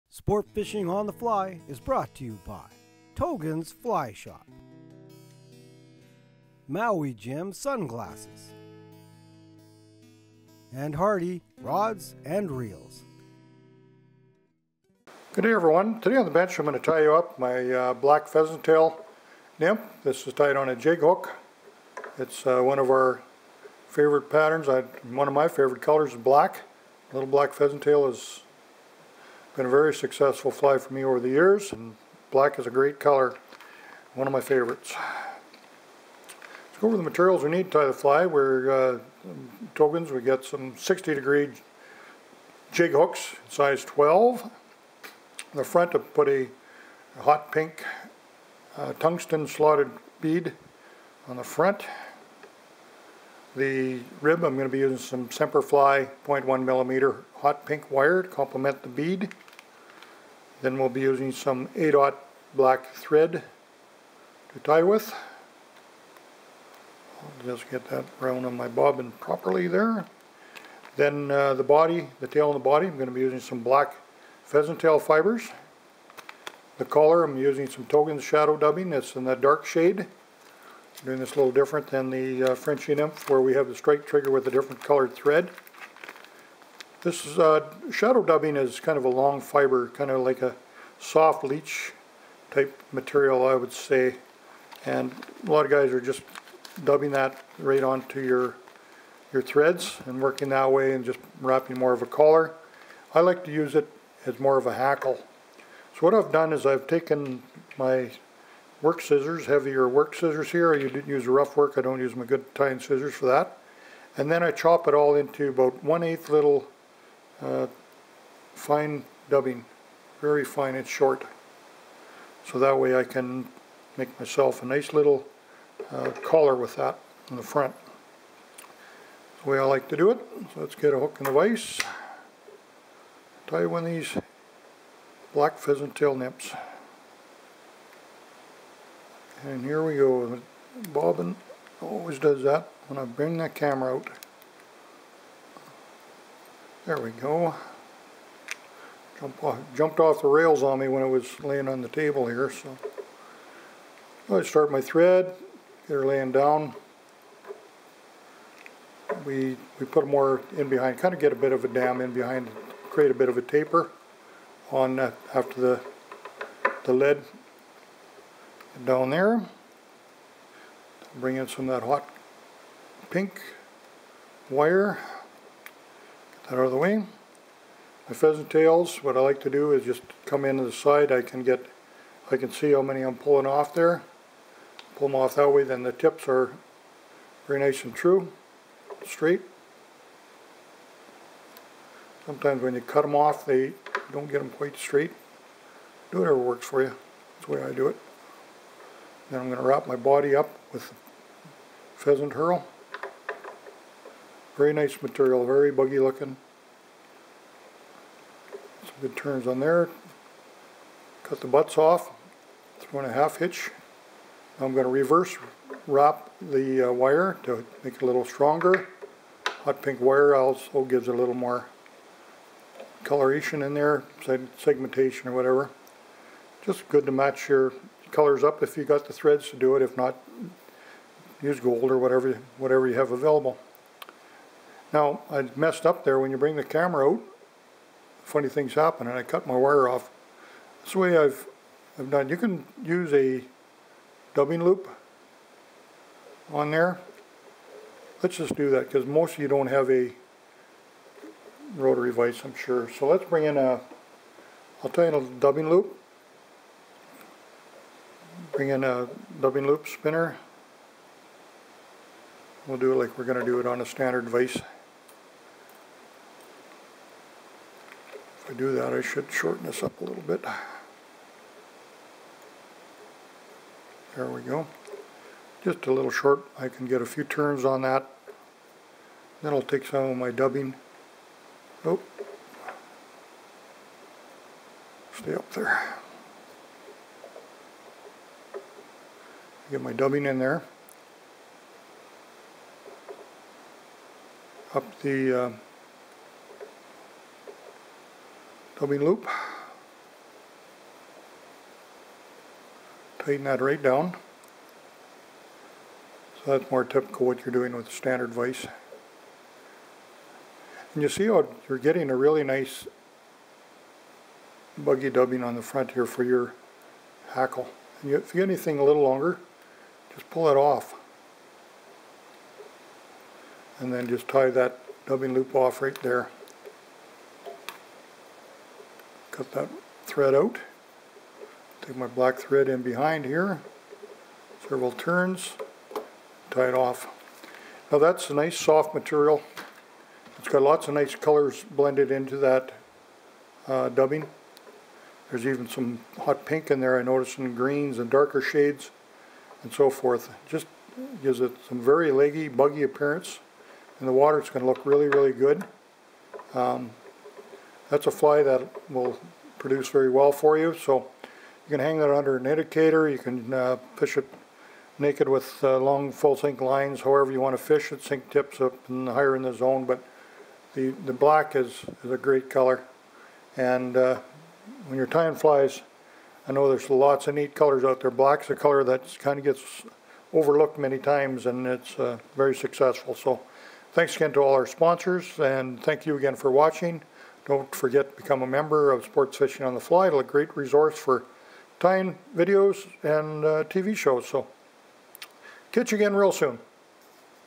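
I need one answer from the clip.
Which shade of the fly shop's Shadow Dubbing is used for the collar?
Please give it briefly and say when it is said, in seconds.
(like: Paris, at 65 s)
dark, at 79 s.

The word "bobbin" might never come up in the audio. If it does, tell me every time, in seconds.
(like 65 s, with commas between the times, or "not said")
68 s, 140 s.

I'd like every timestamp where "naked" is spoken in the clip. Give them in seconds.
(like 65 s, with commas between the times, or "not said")
364 s.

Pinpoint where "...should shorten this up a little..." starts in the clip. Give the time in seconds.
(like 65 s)
269 s.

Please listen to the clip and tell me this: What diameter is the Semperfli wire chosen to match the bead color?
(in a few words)
0.1 millimeter.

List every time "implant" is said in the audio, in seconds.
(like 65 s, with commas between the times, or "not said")
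not said.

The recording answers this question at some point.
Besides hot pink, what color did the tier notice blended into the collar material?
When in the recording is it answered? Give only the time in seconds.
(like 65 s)
347 s.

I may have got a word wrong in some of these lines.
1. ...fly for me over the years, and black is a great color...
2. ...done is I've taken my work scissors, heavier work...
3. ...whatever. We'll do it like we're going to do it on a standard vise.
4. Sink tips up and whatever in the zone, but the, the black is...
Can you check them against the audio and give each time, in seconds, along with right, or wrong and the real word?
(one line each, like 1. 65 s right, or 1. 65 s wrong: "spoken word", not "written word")
1. 30 s right
2. 106 s right
3. 259 s wrong: "spinner", not "whatever"
4. 368 s wrong: "higher", not "whatever".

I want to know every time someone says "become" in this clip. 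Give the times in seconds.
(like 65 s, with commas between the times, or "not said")
388 s.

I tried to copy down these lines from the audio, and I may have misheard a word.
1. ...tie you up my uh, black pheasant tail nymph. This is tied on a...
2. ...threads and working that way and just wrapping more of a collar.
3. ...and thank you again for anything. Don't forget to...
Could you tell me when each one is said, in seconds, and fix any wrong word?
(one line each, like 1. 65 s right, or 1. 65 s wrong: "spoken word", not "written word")
1. 16 s right
2. 99 s right
3. 385 s wrong: "watching", not "anything".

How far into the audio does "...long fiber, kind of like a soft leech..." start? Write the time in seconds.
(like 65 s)
89 s.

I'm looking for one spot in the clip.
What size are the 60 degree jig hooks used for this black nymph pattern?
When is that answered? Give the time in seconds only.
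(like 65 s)
43 s.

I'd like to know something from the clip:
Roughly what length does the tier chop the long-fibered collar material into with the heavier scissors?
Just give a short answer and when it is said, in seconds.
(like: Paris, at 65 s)
one eighth, at 115 s.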